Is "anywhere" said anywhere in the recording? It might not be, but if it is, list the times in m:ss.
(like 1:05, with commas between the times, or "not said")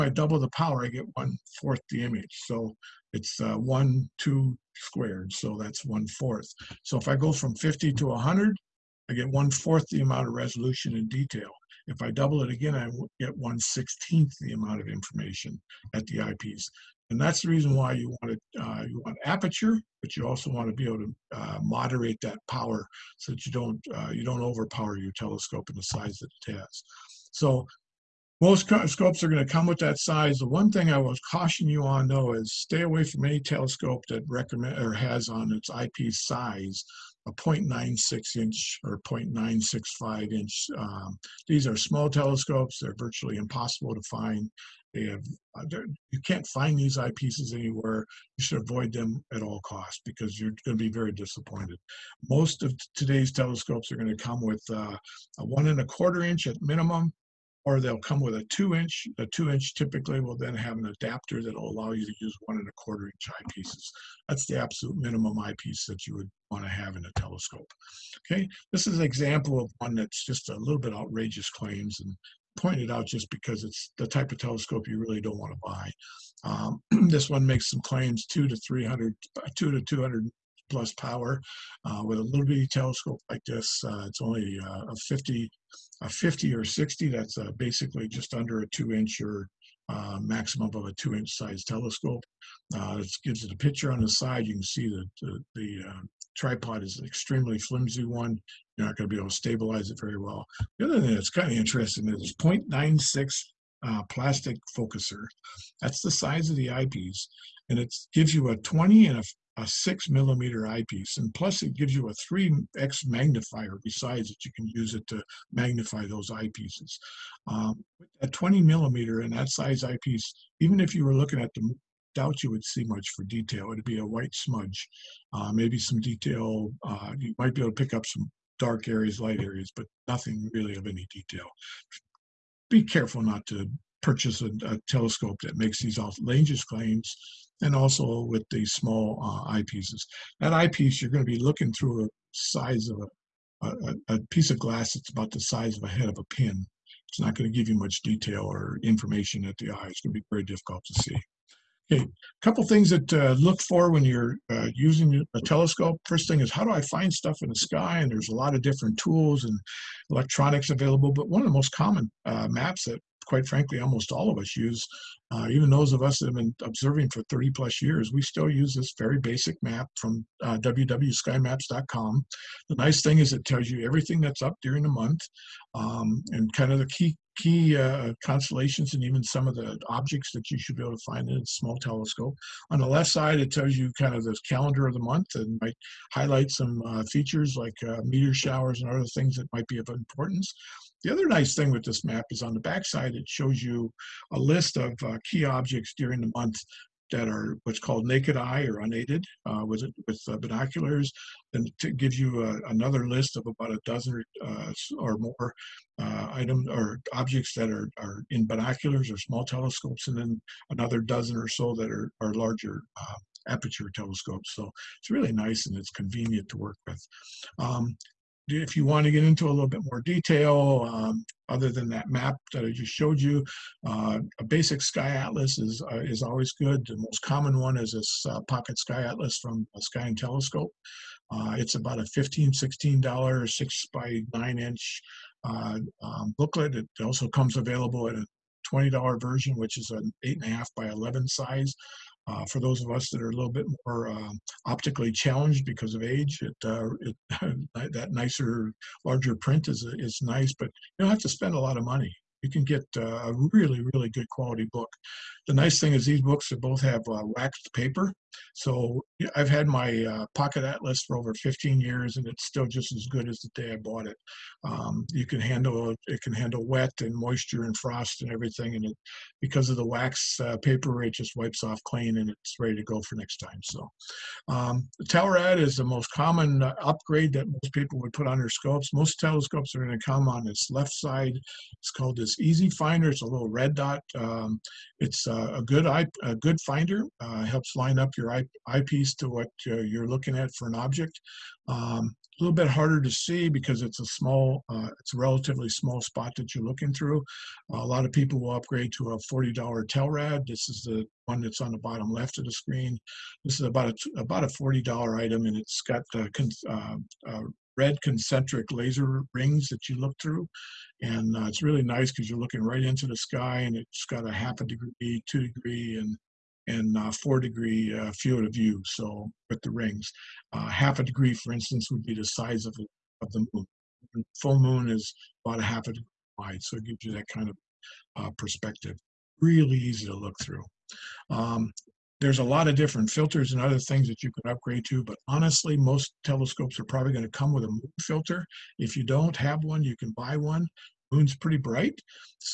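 0:47.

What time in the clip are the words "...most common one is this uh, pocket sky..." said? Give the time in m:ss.
3:46.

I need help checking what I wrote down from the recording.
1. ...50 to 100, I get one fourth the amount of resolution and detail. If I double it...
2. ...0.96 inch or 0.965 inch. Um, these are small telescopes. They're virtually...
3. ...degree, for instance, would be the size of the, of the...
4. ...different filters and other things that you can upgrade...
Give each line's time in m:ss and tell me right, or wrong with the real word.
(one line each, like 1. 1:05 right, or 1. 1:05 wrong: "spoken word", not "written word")
1. 0:07 right
2. 0:37 right
3. 5:21 right
4. 5:32 right.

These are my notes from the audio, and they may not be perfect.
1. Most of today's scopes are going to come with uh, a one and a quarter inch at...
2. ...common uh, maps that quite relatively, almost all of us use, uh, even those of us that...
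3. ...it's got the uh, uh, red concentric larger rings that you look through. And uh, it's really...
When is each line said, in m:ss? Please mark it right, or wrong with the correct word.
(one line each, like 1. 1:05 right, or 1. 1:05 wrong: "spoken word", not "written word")
1. 0:52 wrong: "telescopes", not "scopes"
2. 2:41 wrong: "frankly", not "relatively"
3. 5:05 wrong: "laser", not "larger".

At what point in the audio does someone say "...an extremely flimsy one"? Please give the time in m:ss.
1:36.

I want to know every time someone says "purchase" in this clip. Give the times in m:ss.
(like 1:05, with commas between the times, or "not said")
2:14.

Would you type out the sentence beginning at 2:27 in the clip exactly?
It's not going to give you much detail or information at the eye.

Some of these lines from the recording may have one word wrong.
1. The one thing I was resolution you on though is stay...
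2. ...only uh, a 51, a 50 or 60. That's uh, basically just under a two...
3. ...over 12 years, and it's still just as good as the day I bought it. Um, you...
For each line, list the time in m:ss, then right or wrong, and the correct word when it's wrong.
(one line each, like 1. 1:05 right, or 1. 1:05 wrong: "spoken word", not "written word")
1. 0:30 wrong: "caution", not "resolution"
2. 1:24 wrong: "50", not "51"
3. 4:21 wrong: "15", not "12".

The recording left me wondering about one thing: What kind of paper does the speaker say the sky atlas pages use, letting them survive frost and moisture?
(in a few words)
Waxed paper.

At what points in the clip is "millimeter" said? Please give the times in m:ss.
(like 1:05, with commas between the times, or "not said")
1:50, 1:58.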